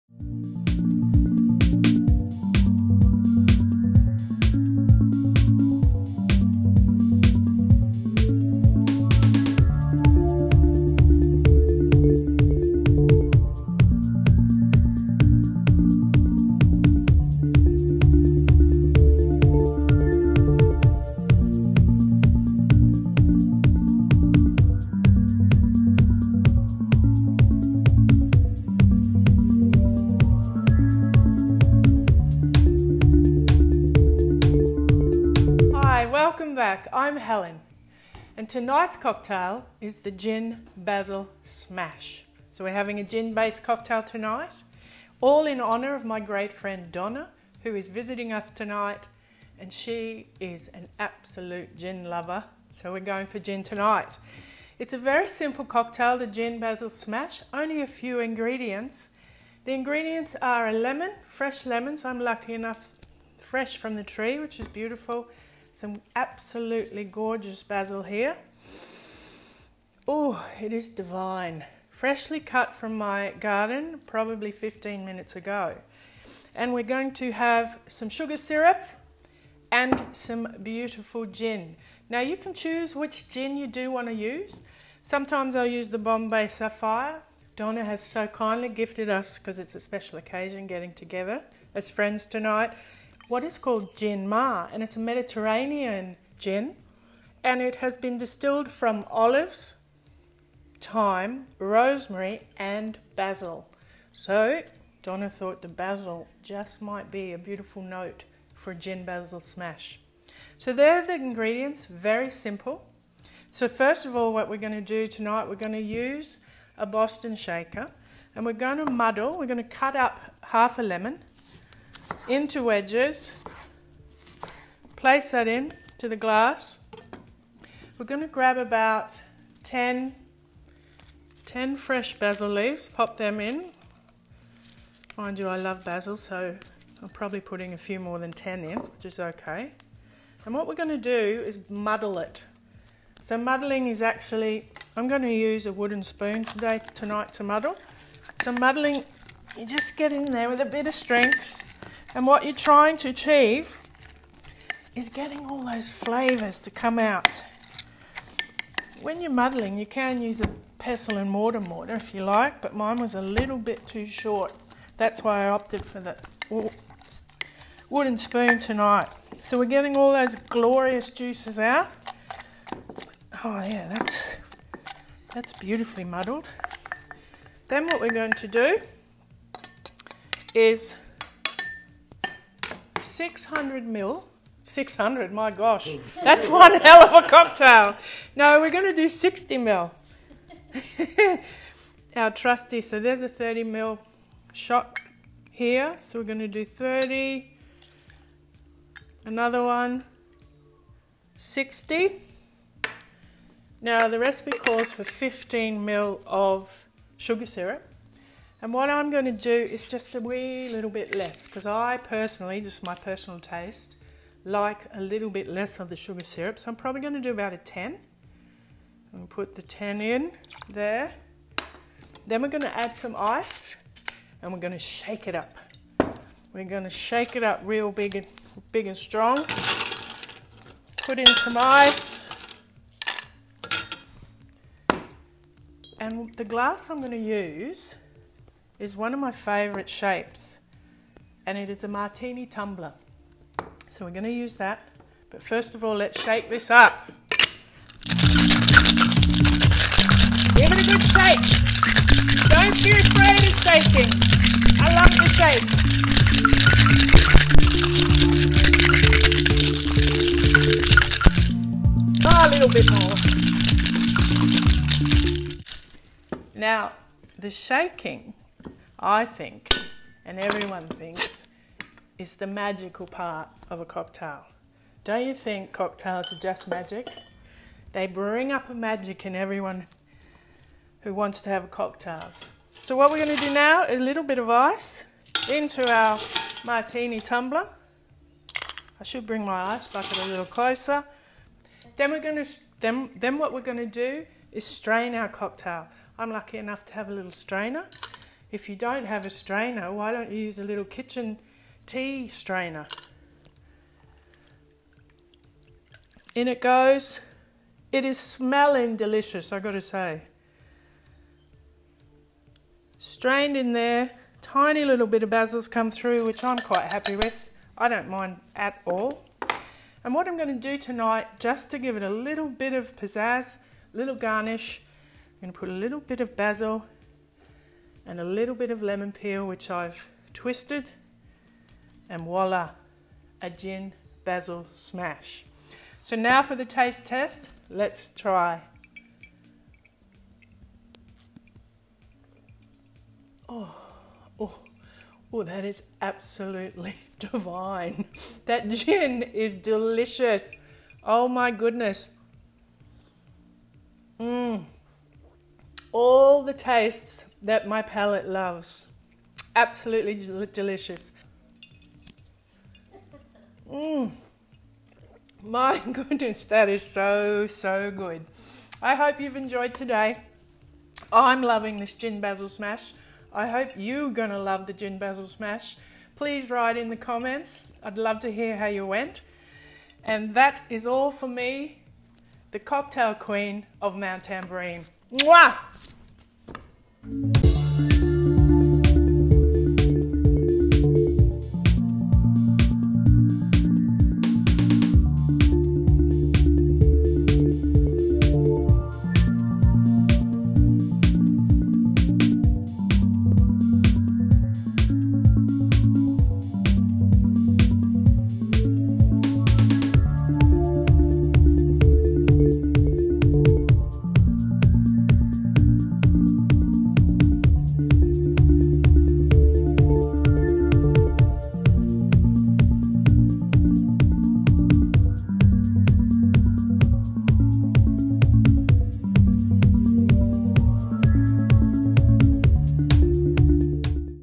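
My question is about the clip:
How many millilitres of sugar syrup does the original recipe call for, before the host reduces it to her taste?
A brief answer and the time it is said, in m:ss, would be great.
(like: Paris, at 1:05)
15 ml, at 3:25.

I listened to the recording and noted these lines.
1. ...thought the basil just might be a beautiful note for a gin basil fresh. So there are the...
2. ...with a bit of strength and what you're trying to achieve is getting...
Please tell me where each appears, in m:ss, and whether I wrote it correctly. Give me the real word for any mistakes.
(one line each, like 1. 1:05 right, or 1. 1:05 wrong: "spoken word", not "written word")
1. 1:45 wrong: "smash", not "fresh"
2. 2:30 right.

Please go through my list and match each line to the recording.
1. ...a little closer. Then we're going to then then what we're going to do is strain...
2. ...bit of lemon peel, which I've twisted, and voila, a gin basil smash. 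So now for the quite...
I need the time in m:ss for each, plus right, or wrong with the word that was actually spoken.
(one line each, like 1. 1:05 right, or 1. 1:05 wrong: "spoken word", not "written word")
1. 4:50 right
2. 5:28 wrong: "taste", not "quite".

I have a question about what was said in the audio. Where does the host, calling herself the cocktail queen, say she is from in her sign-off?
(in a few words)
Mount Tamborine.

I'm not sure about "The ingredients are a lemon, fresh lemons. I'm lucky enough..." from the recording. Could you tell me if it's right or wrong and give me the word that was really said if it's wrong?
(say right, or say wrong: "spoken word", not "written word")
right.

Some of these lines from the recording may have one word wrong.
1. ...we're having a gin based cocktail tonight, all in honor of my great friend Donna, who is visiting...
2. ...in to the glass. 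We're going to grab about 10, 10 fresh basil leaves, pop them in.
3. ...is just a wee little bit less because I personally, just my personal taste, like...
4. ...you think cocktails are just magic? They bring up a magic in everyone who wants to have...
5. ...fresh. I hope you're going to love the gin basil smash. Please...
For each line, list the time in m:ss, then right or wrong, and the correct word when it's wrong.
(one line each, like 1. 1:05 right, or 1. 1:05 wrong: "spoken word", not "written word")
1. 0:42 right
2. 2:05 right
3. 3:29 right
4. 4:35 right
5. 6:12 wrong: "smash", not "fresh".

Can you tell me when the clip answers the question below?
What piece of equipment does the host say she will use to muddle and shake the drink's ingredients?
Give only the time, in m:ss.
1:56.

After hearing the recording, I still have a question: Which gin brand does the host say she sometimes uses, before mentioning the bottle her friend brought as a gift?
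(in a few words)
Bombay Sapphire.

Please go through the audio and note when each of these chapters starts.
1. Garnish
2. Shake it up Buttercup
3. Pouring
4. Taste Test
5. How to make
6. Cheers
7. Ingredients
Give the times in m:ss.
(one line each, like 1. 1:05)
1. 5:23
2. 4:05
3. 4:55
4. 5:36
5. 1:54
6. 6:43
7. 0:58.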